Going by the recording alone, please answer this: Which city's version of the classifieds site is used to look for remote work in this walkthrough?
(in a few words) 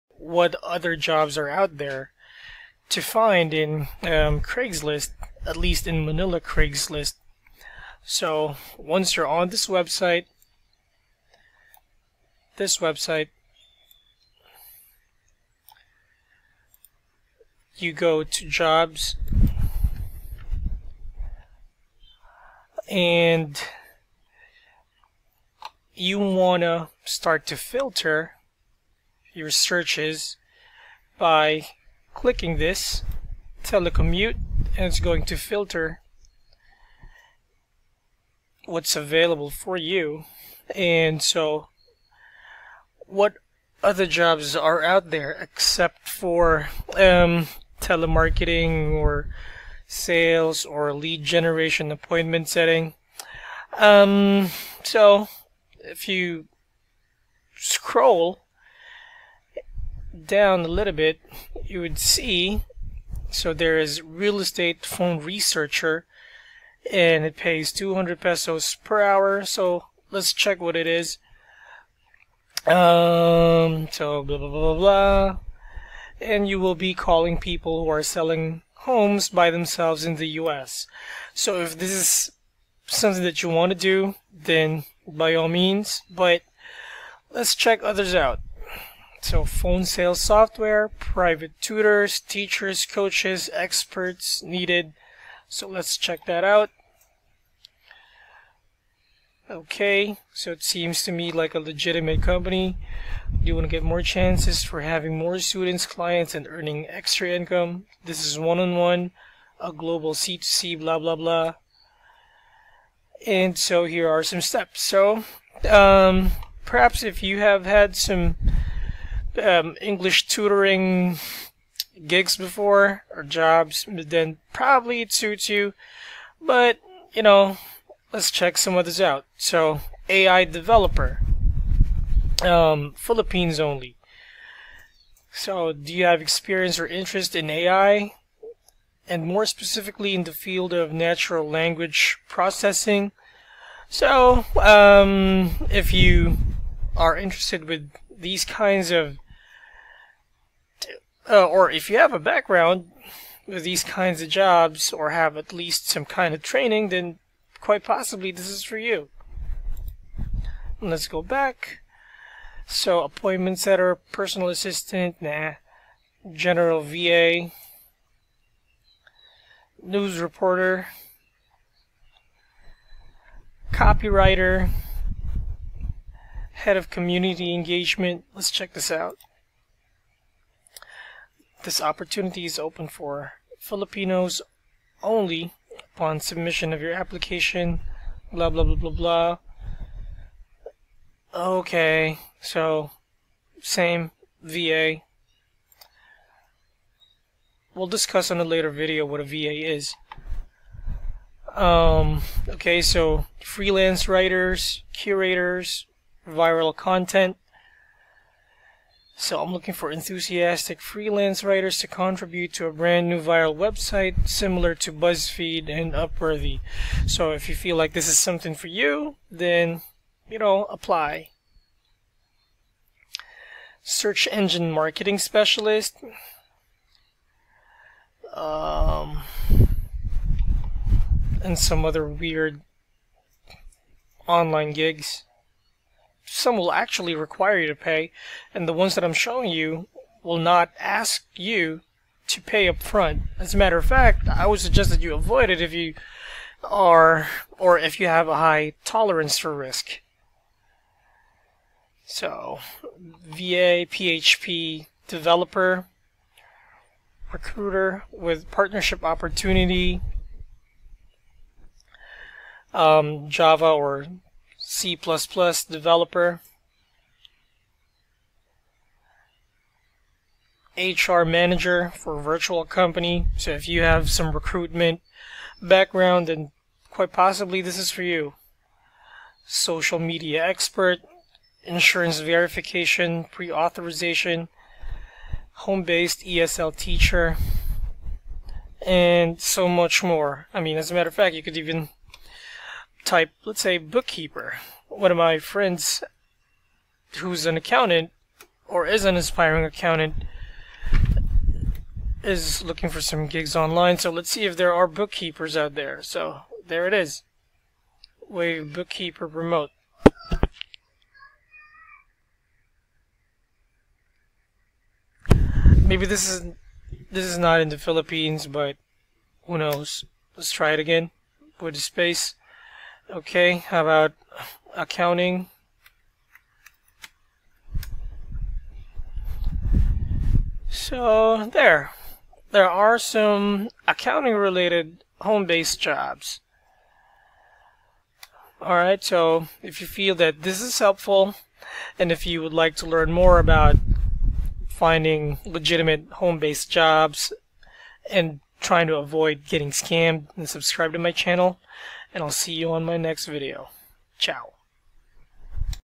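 Manila.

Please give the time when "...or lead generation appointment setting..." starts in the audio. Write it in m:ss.
0:50.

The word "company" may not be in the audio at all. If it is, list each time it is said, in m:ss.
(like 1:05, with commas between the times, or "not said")
1:42, 4:32.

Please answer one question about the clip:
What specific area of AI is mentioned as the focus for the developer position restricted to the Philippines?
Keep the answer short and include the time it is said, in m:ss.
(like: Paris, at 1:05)
natural language processing, at 2:20.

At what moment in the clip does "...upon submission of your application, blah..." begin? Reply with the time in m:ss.
3:05.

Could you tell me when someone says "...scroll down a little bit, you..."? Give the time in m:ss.
0:57.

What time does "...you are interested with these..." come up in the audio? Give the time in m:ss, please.
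2:25.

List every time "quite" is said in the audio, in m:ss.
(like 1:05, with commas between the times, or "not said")
2:37, 4:36.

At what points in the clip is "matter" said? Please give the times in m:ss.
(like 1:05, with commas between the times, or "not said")
4:03, 4:50.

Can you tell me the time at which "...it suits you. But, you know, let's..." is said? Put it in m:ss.
2:05.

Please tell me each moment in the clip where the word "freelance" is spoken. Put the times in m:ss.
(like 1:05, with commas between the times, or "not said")
3:23, 3:30.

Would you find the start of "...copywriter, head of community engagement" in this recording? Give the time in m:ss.
2:53.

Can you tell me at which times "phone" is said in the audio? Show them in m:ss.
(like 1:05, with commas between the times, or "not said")
1:04, 1:29.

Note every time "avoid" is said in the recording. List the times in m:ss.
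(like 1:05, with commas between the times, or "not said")
4:05, 5:48.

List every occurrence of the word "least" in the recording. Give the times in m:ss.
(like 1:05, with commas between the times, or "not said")
0:05, 2:35.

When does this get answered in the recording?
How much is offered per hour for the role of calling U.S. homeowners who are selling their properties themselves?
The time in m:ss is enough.
1:07.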